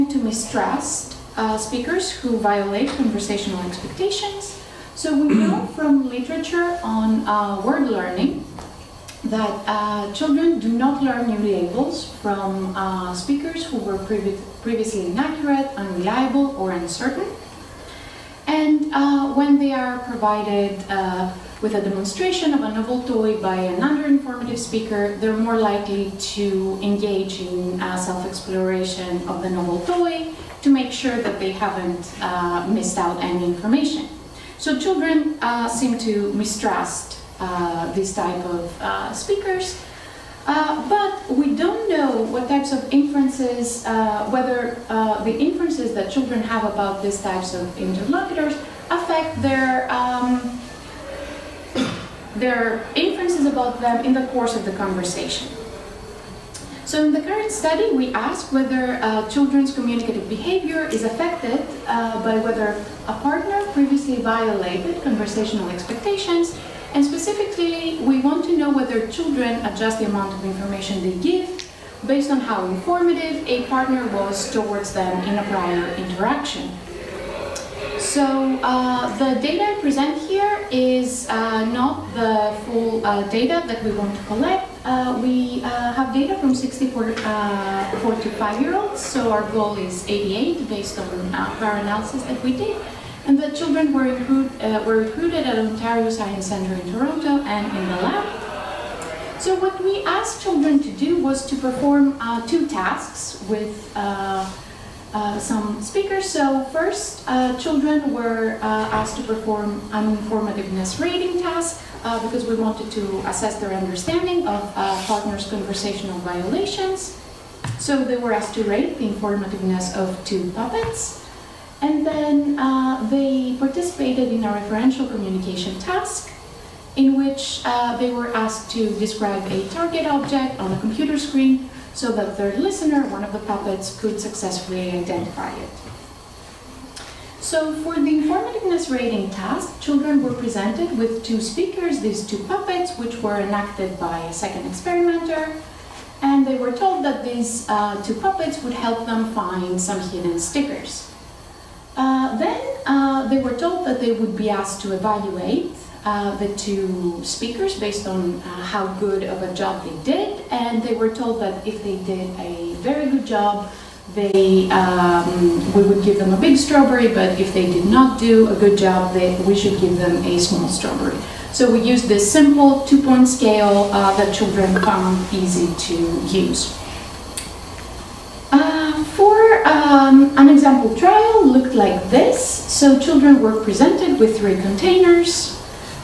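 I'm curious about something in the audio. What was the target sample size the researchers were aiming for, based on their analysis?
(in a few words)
88.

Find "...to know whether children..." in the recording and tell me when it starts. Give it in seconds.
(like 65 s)
68 s.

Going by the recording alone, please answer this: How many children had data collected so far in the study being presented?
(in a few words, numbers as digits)
64.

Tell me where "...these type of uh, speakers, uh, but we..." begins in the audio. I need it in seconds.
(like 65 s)
37 s.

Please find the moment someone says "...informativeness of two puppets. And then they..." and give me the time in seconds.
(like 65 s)
119 s.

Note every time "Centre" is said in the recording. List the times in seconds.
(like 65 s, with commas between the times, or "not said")
96 s.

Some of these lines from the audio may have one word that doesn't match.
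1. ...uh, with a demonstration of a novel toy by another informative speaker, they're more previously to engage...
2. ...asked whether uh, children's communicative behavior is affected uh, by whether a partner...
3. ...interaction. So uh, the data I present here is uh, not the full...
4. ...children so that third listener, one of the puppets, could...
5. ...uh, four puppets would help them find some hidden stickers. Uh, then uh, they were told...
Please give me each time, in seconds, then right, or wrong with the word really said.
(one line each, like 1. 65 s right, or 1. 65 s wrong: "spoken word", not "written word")
1. 20 s wrong: "likely", not "previously"
2. 58 s right
3. 75 s right
4. 131 s wrong: "screen", not "children"
5. 147 s wrong: "two", not "four".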